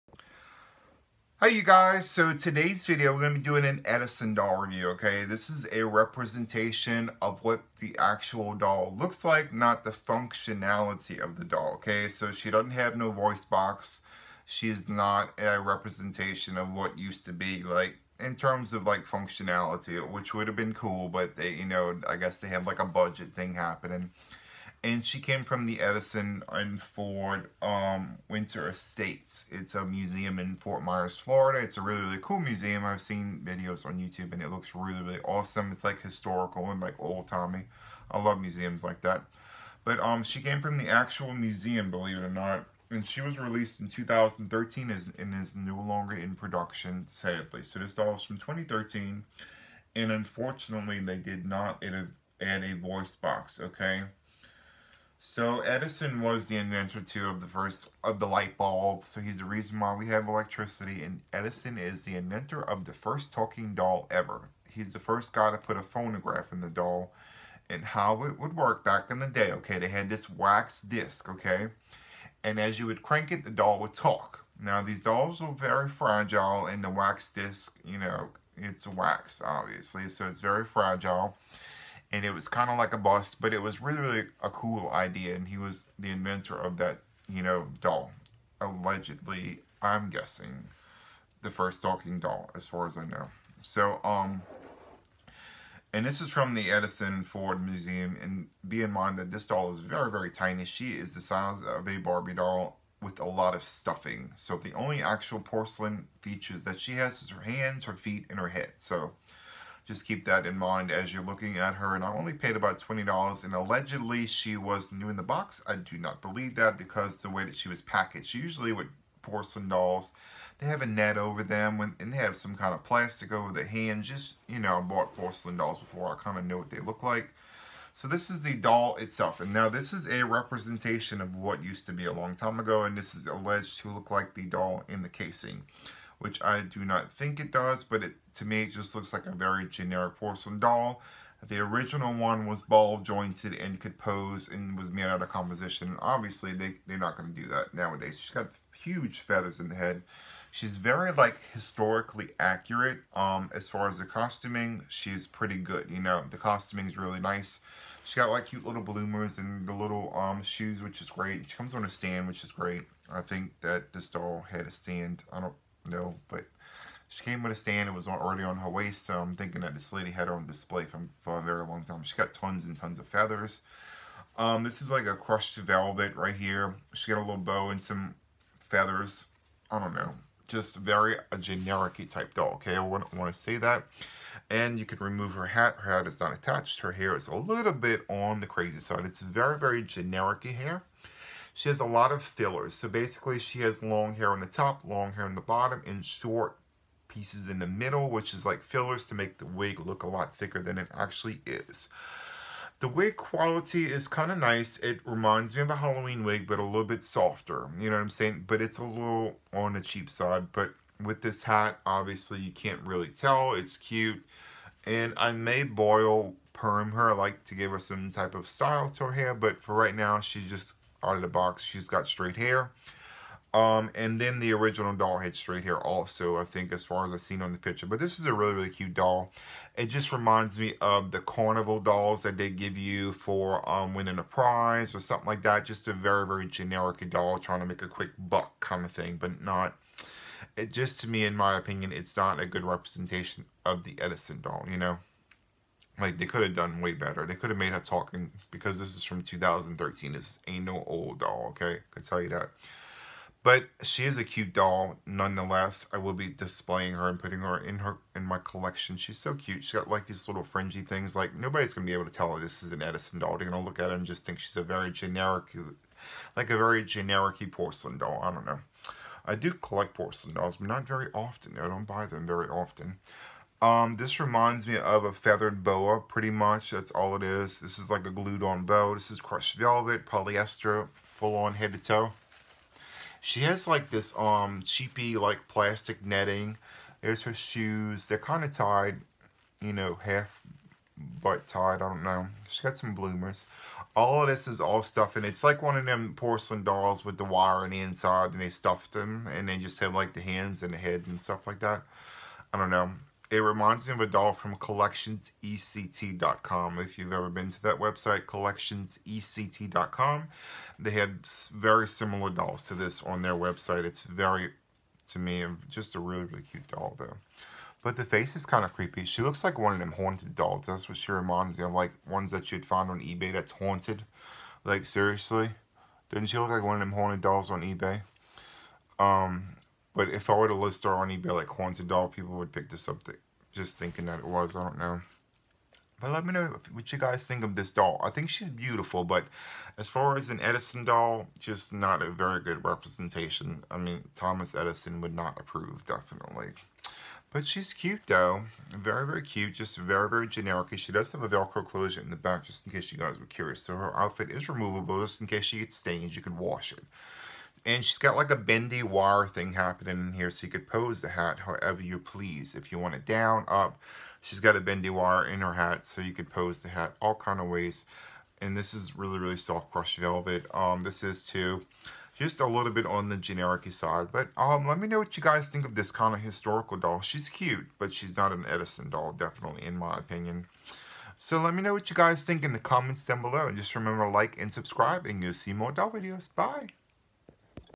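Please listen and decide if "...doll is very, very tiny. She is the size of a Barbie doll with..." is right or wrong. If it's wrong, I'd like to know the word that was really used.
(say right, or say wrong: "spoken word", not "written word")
right.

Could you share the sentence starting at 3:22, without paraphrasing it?
The wig quality is kind of nice.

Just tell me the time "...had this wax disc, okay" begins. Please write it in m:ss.
1:09.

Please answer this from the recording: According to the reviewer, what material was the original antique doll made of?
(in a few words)
composition.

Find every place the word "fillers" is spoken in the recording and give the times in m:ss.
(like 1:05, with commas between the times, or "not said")
3:12, 3:18.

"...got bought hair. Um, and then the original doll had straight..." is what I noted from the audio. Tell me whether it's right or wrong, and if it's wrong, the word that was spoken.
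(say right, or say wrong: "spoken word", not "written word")
wrong: "straight", not "bought".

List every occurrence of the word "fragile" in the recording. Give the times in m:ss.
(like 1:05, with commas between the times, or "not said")
1:15, 1:20.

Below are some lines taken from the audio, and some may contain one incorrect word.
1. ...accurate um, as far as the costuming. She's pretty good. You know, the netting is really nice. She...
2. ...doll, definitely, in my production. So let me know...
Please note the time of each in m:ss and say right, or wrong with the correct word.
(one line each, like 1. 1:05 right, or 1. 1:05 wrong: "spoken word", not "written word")
1. 2:32 wrong: "costuming", not "netting"
2. 6:18 wrong: "opinion", not "production".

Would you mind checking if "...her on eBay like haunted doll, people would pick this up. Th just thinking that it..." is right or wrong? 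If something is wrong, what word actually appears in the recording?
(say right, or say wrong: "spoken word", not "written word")
right.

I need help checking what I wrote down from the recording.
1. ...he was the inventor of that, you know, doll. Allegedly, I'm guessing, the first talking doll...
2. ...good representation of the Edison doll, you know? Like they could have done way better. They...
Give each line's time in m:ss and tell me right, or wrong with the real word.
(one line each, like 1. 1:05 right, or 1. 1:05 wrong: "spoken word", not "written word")
1. 1:25 right
2. 4:02 right.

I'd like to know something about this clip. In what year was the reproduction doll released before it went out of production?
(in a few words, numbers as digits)
2013.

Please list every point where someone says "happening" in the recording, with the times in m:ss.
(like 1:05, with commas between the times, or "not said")
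0:23, 5:59.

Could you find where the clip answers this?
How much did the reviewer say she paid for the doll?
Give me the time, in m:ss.
1:52.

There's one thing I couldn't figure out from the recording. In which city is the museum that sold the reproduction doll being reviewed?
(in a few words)
Fort Myers.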